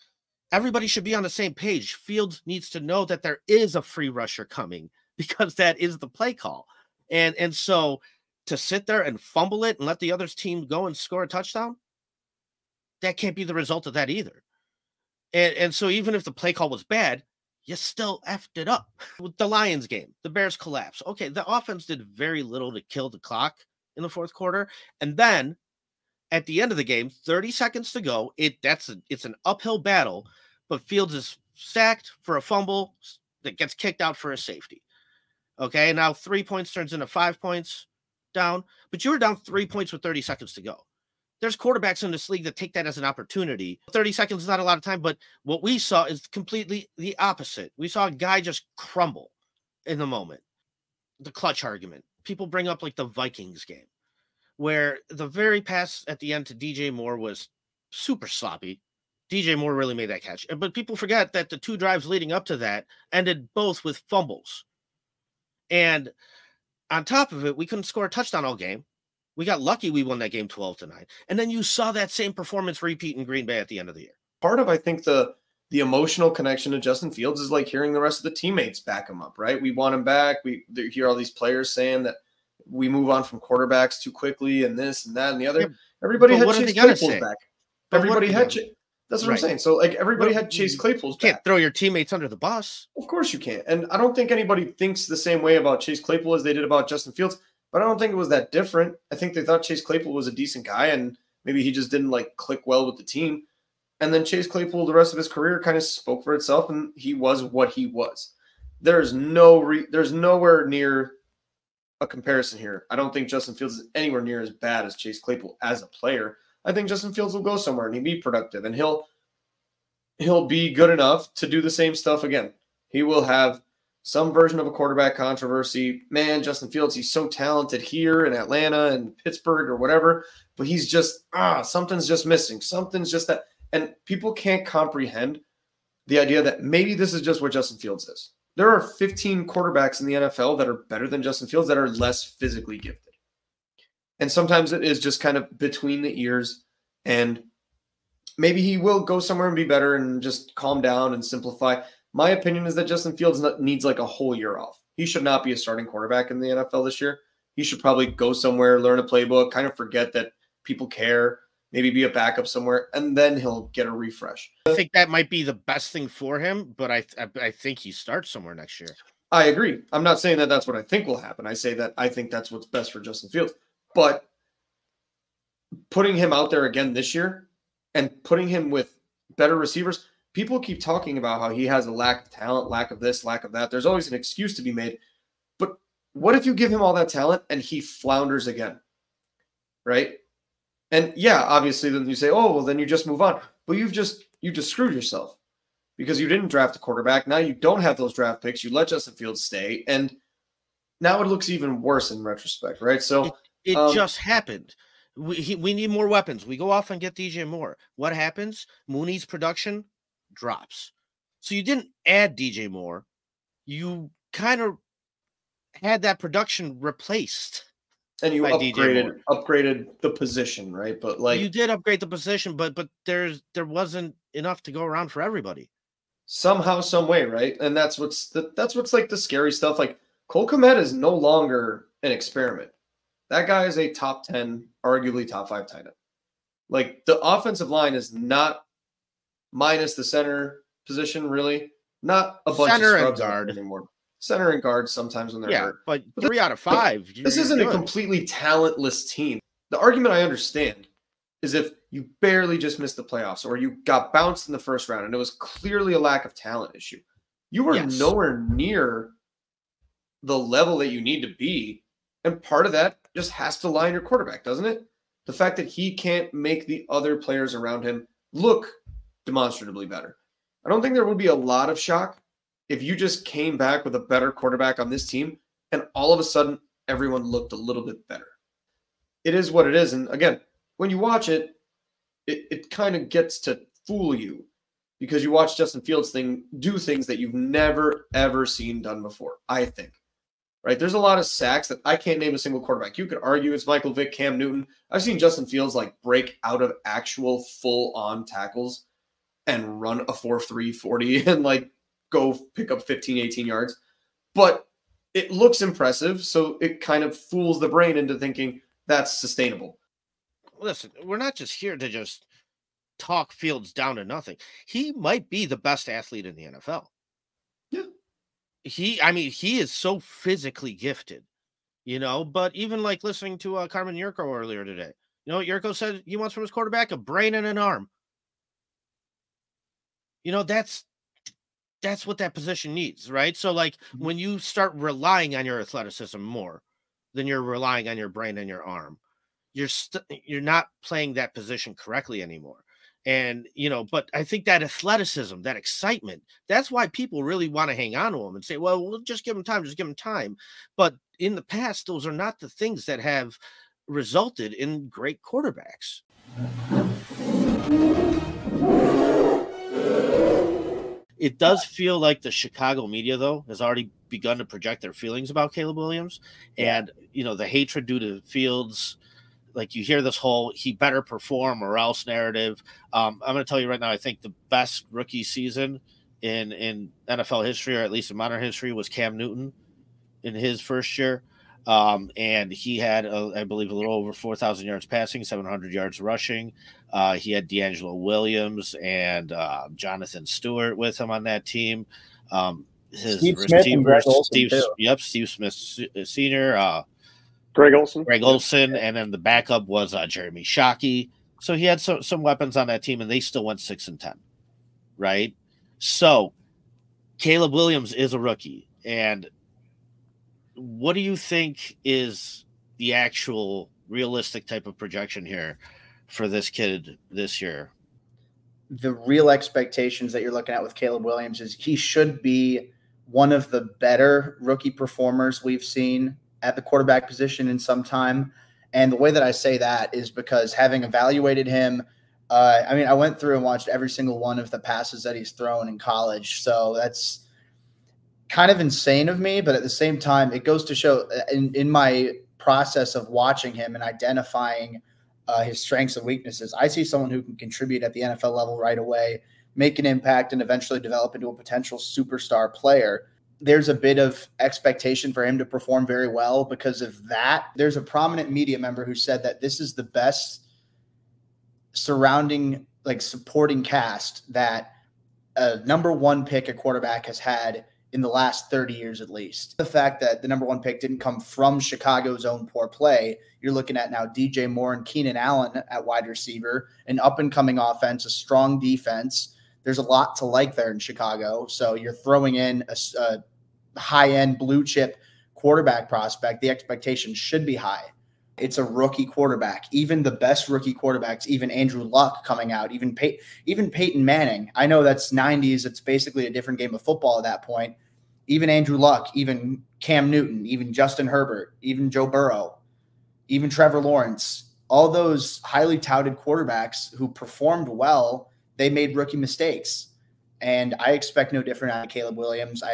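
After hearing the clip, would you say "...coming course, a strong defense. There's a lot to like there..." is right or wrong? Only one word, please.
wrong.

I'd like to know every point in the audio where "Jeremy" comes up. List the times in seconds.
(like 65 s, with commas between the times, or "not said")
400 s.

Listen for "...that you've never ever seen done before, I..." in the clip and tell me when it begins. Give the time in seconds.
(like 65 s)
287 s.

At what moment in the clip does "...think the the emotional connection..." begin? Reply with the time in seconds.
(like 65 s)
74 s.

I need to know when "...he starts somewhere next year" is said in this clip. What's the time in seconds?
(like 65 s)
167 s.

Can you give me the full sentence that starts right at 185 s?
But what if you give him all that talent and he flounders again?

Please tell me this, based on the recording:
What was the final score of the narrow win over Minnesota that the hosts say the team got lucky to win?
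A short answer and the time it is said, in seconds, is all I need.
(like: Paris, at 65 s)
12 to 9, at 70 s.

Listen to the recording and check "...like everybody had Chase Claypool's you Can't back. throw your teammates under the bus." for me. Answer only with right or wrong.
right.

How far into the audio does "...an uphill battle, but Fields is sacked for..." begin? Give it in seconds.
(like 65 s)
29 s.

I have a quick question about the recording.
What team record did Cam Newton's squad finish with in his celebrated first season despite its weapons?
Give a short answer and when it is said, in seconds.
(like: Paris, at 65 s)
6 and 10, at 403 s.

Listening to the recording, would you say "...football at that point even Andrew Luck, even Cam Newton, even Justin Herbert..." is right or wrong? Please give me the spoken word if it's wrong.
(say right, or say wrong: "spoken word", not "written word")
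right.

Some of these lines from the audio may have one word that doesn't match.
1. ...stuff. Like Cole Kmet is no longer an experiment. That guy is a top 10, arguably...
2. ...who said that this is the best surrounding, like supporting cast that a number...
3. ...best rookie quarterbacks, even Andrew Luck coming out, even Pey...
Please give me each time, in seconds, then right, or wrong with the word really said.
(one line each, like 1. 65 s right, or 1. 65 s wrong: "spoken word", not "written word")
1. 229 s right
2. 458 s right
3. 490 s right.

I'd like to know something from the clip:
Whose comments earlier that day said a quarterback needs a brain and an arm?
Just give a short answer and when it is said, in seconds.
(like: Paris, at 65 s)
Carmen Yurko, at 323 s.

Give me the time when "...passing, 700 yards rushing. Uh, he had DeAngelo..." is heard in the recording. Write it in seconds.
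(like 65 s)
384 s.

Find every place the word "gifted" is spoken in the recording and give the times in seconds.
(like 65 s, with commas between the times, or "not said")
142 s, 320 s.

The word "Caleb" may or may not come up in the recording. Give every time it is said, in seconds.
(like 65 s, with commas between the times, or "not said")
365 s, 407 s, 420 s, 511 s.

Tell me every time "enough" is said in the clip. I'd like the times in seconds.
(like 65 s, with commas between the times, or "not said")
120 s, 224 s.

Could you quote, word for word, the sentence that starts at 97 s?
But I don't think it was that different.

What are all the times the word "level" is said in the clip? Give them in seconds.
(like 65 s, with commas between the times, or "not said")
260 s, 448 s.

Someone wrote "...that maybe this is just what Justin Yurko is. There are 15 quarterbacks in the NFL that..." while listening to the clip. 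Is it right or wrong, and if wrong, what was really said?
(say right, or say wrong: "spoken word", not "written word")
wrong: "Fields", not "Yurko".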